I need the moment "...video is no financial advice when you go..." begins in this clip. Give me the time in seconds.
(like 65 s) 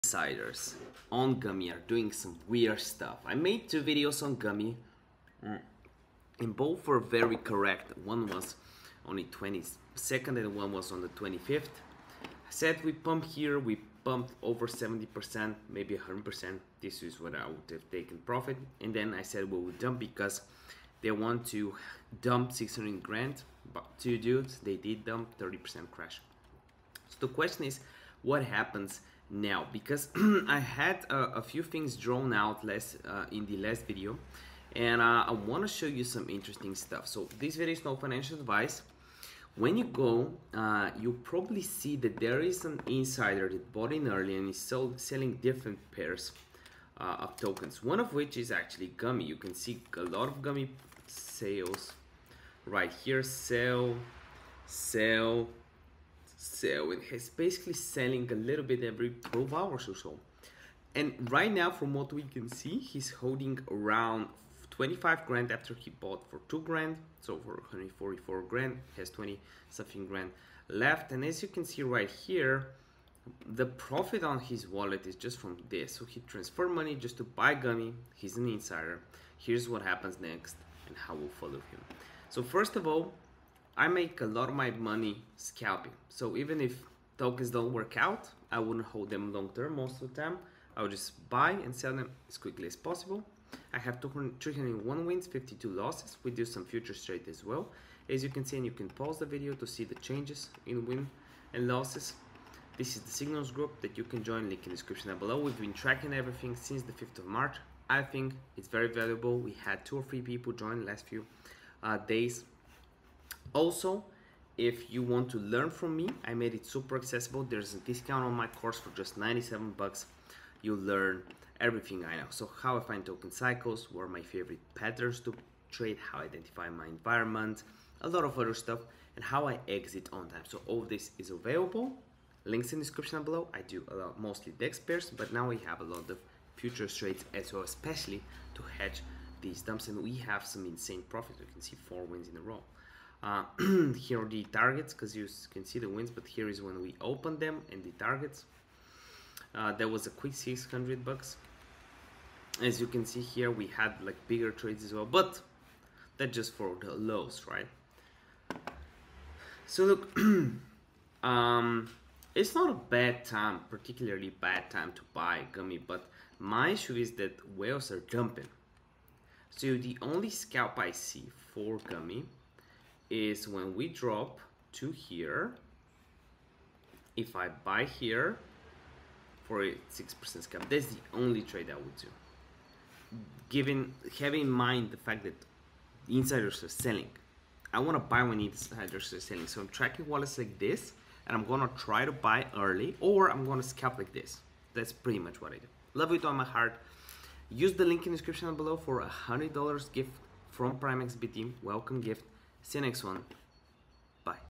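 37 s.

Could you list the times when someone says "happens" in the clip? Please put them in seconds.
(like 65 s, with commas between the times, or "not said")
28 s, 79 s.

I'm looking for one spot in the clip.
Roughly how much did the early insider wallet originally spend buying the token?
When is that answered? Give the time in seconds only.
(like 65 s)
66 s.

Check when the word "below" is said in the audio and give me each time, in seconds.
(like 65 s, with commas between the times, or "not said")
105 s, 133 s, 198 s.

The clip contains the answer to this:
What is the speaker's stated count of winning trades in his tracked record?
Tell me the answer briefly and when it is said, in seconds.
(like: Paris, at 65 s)
301, at 94 s.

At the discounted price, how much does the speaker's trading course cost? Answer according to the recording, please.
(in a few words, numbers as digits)
97 bucks.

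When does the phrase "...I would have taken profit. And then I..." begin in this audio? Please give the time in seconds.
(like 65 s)
17 s.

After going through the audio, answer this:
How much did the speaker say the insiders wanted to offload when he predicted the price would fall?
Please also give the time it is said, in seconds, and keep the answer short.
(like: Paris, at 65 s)
600 grand, at 22 s.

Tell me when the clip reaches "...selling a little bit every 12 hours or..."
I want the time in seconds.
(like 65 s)
57 s.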